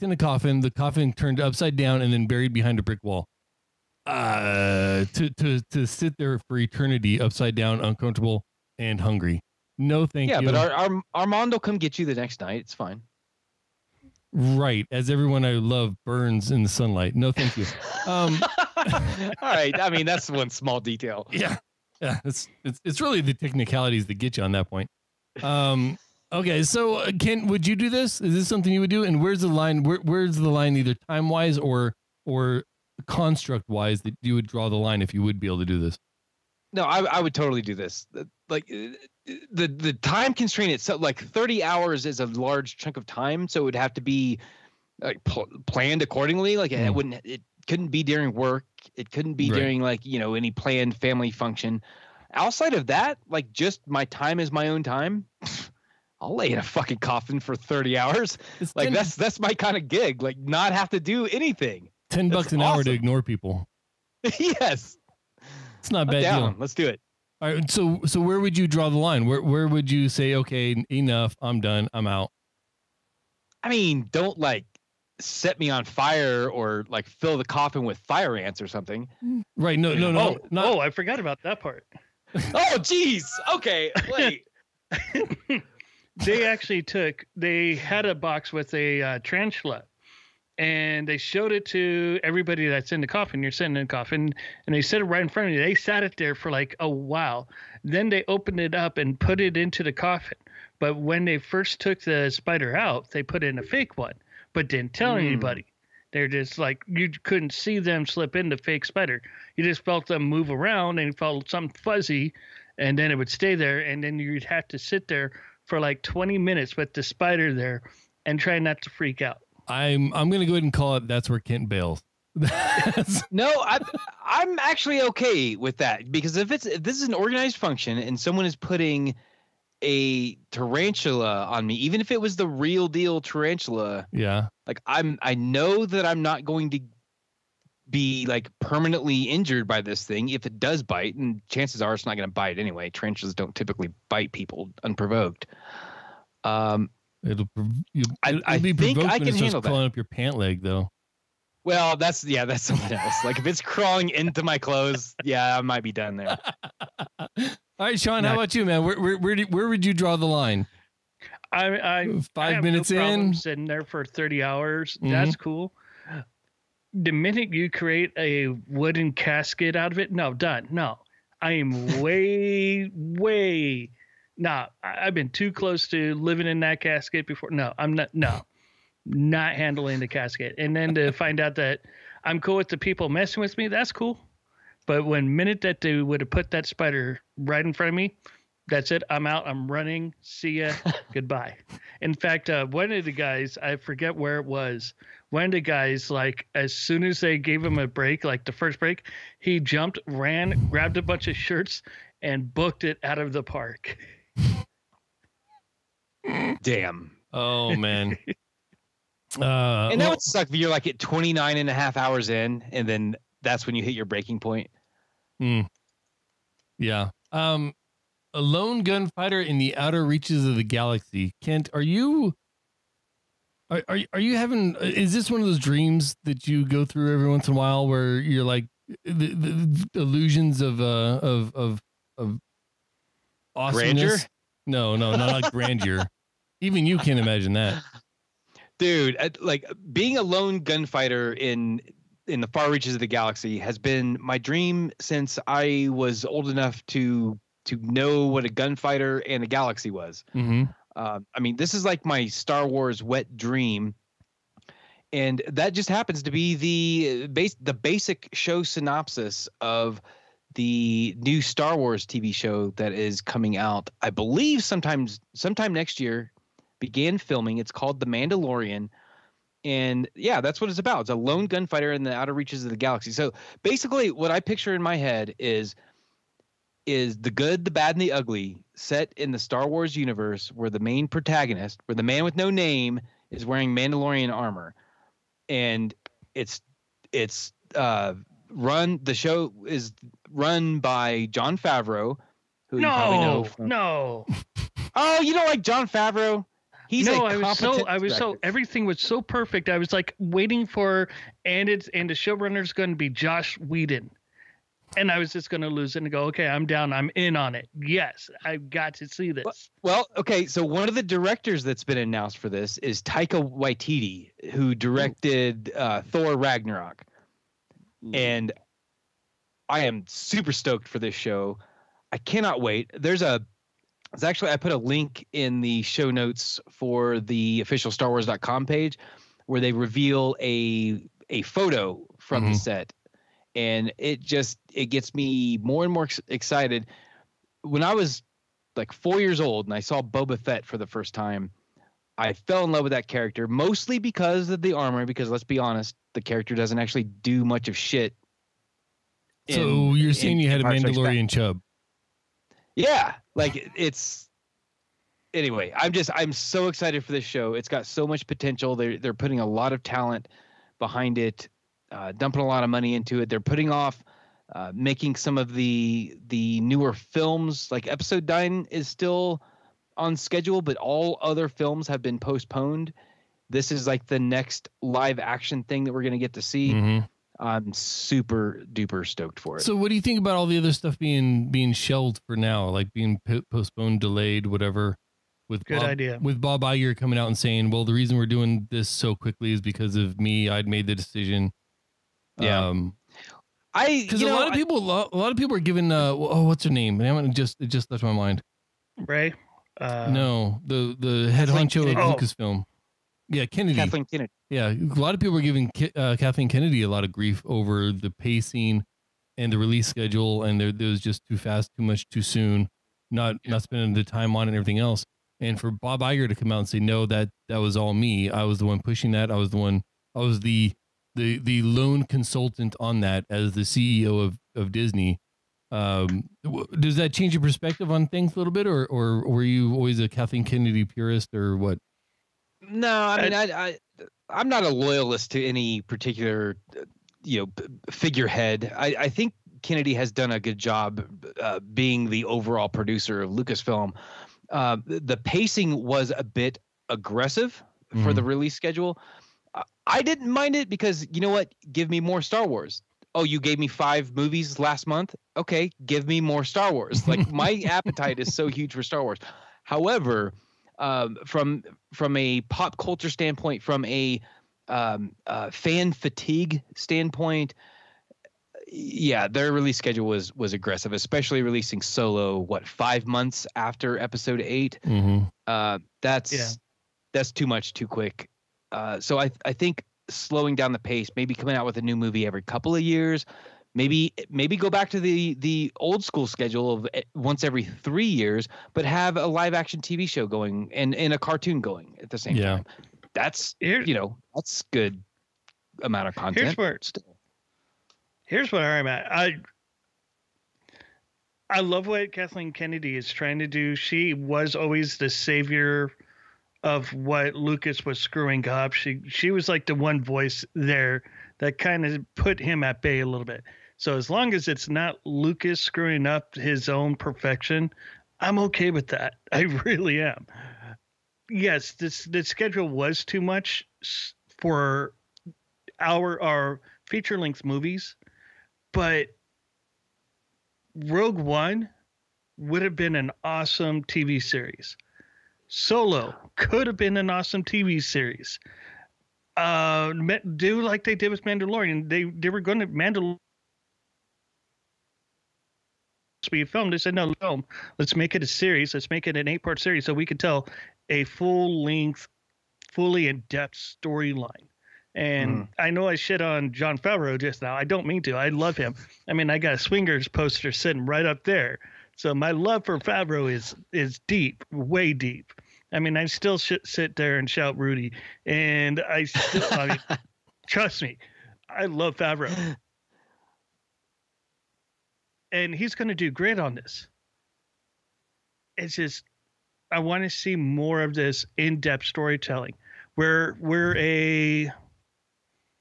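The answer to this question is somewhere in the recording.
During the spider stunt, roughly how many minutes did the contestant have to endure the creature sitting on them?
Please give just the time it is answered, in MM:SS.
01:56.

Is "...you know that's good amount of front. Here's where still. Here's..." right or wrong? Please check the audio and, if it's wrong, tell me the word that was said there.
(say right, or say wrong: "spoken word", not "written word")
wrong: "content", not "front".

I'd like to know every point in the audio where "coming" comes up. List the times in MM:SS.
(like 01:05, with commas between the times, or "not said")
04:23, 06:26, 08:01.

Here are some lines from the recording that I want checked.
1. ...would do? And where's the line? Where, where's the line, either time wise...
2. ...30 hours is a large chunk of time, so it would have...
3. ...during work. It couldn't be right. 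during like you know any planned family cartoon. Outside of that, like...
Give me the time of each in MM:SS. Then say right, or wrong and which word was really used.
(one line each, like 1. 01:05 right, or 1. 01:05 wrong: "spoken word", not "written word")
1. 00:28 right
2. 00:41 right
3. 00:48 wrong: "function", not "cartoon".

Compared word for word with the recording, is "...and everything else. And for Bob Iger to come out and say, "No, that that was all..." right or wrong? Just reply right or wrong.
right.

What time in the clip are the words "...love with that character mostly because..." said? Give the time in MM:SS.
05:42.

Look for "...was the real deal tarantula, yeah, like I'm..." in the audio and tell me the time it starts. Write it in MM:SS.
02:12.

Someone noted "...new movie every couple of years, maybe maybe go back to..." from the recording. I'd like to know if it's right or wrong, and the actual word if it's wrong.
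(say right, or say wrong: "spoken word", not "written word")
right.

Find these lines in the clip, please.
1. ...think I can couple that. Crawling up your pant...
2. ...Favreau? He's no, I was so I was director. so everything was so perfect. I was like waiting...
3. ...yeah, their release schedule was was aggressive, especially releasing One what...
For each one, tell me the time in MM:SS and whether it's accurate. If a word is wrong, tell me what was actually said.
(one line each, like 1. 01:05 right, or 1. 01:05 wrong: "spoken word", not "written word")
1. 02:28 wrong: "handle", not "couple"
2. 04:55 right
3. 07:48 wrong: "Solo", not "One".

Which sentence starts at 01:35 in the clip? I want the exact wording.
They sat it there for like a while.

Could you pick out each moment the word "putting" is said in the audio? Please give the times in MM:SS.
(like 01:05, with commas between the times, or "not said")
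02:08, 05:59, 06:03.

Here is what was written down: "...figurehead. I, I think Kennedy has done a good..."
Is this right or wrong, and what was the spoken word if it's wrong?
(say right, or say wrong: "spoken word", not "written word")
right.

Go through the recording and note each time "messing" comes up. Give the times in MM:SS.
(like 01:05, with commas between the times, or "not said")
03:03.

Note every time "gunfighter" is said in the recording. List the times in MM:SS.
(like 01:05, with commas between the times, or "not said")
03:38, 04:00, 04:08, 04:31.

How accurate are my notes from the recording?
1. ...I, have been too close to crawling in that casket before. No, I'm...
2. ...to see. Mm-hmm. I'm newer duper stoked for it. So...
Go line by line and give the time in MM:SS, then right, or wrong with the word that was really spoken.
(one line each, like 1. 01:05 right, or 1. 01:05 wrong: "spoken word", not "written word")
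1. 02:54 wrong: "living", not "crawling"
2. 06:16 wrong: "super", not "newer".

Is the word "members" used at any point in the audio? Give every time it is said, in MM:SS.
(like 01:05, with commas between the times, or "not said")
not said.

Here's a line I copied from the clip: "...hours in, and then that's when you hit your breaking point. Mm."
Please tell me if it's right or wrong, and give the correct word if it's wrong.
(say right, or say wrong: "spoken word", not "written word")
right.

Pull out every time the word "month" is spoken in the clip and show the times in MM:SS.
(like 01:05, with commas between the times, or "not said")
07:34, 07:53.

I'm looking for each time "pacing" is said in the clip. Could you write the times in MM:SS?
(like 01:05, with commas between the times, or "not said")
06:48, 07:25.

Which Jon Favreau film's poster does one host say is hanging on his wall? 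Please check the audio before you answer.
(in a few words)
Swingers.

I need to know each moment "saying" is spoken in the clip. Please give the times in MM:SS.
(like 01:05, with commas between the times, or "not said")
05:50, 06:27.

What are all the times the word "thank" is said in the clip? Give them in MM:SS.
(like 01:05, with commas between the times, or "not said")
00:10, 00:17.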